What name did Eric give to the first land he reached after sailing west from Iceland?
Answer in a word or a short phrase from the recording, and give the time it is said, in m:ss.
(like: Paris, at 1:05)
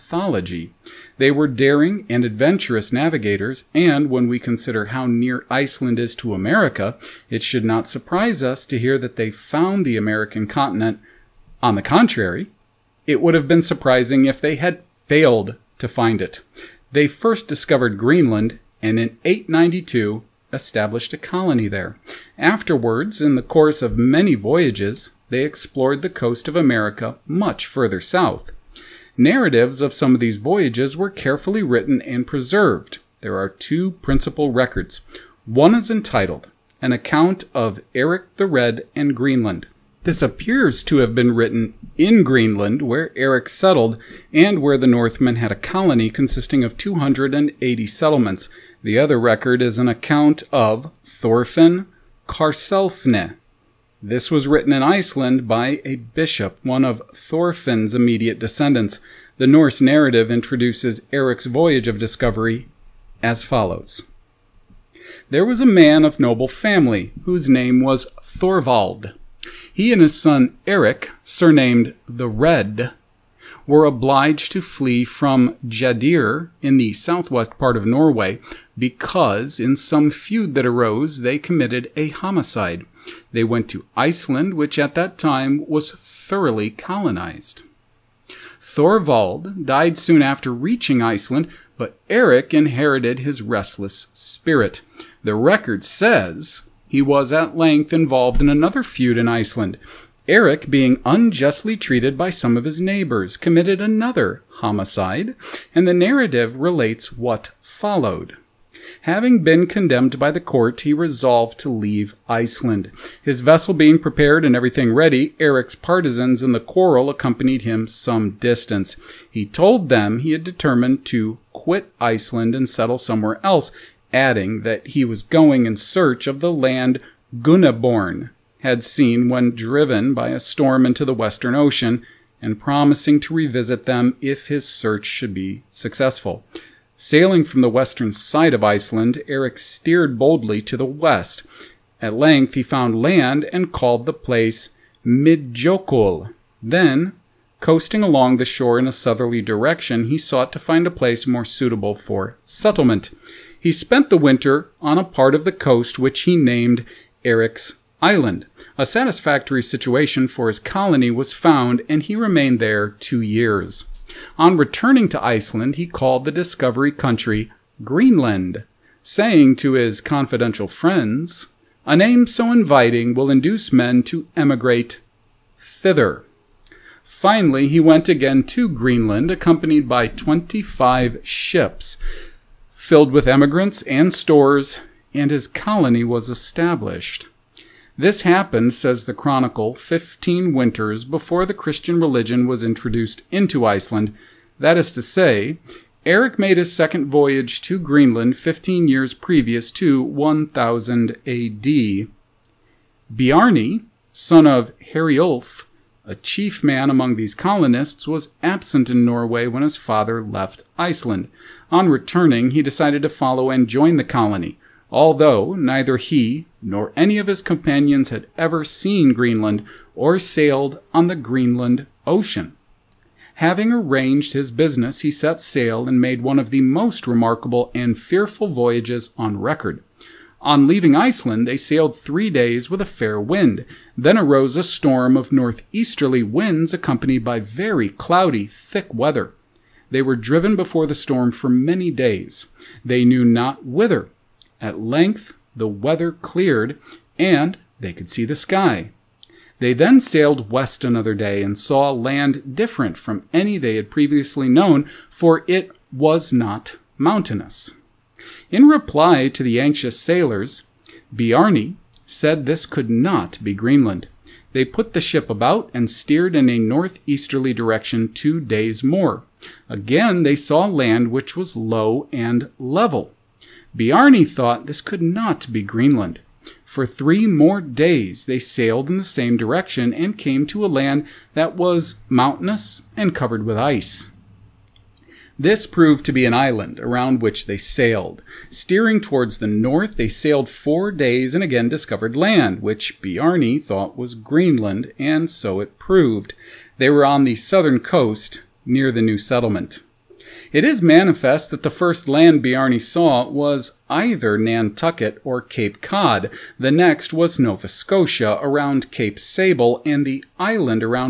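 Midjokul, at 2:25.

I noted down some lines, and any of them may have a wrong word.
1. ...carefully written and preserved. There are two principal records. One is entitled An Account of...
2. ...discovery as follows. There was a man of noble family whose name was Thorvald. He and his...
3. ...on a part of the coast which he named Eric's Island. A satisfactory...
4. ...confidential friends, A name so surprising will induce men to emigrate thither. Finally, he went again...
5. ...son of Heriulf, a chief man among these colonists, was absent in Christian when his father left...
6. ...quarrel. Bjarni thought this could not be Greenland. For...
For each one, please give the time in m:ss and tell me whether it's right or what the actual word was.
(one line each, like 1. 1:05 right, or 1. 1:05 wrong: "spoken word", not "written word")
1. 0:31 right
2. 1:01 right
3. 2:34 right
4. 2:50 wrong: "inviting", not "surprising"
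5. 3:24 wrong: "Norway", not "Christian"
6. 4:32 wrong: "level", not "quarrel".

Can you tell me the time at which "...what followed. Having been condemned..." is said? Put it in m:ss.
1:47.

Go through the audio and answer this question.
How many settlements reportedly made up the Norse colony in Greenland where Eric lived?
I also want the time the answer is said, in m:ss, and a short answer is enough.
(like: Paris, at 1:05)
280, at 0:46.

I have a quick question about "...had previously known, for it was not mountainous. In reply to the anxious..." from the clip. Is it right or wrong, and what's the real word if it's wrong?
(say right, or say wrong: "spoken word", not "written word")
right.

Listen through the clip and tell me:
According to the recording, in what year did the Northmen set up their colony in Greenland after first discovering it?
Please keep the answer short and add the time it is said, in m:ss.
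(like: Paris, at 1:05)
892, at 0:19.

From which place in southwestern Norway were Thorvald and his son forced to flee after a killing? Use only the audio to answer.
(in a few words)
Jadir.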